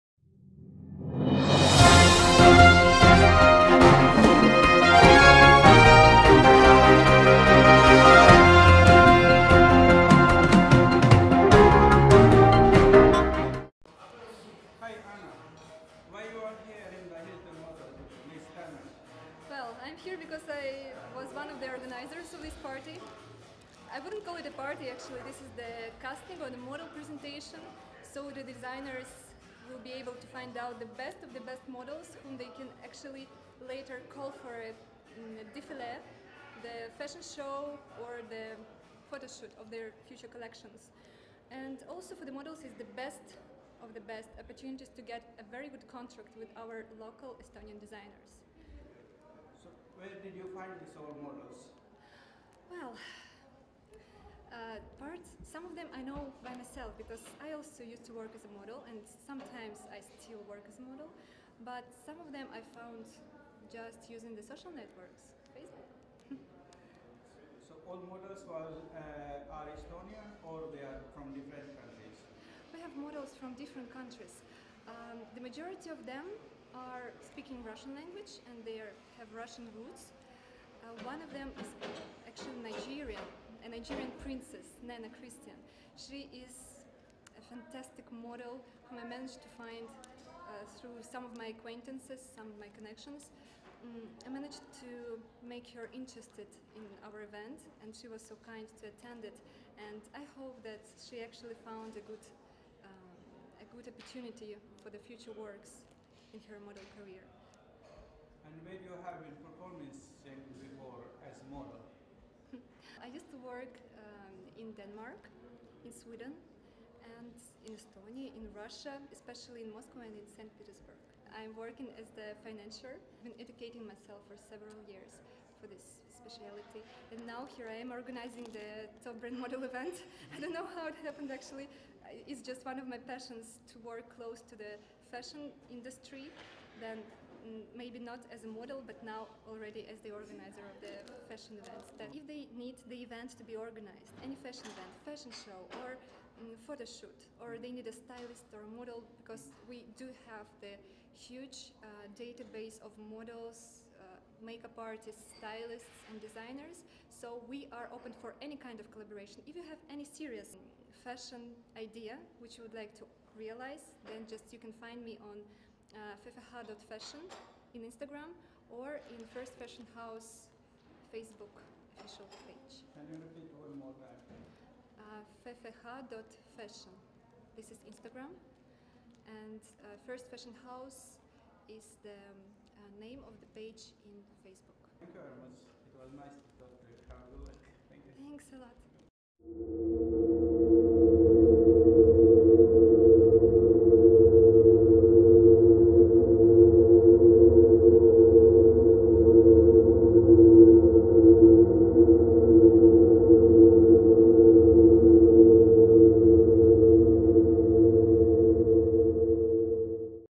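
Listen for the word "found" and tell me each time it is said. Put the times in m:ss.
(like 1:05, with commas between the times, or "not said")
1:02, 1:41.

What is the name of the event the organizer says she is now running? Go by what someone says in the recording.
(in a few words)
Top Brand Model.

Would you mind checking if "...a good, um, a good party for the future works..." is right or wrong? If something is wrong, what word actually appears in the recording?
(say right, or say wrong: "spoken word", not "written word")
wrong: "opportunity", not "party".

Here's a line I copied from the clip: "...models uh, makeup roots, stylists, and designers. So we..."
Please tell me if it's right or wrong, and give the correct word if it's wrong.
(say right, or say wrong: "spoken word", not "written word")
wrong: "artists", not "roots".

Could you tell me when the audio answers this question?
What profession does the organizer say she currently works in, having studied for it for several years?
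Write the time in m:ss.
2:02.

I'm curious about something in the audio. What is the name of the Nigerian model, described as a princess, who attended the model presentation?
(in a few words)
Nana Christian.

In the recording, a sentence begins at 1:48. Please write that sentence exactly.
And maybe you have been performing before as model.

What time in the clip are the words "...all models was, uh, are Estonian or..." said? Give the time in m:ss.
1:07.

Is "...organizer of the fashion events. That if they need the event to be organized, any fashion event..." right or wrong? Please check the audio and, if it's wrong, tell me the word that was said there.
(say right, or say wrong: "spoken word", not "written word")
right.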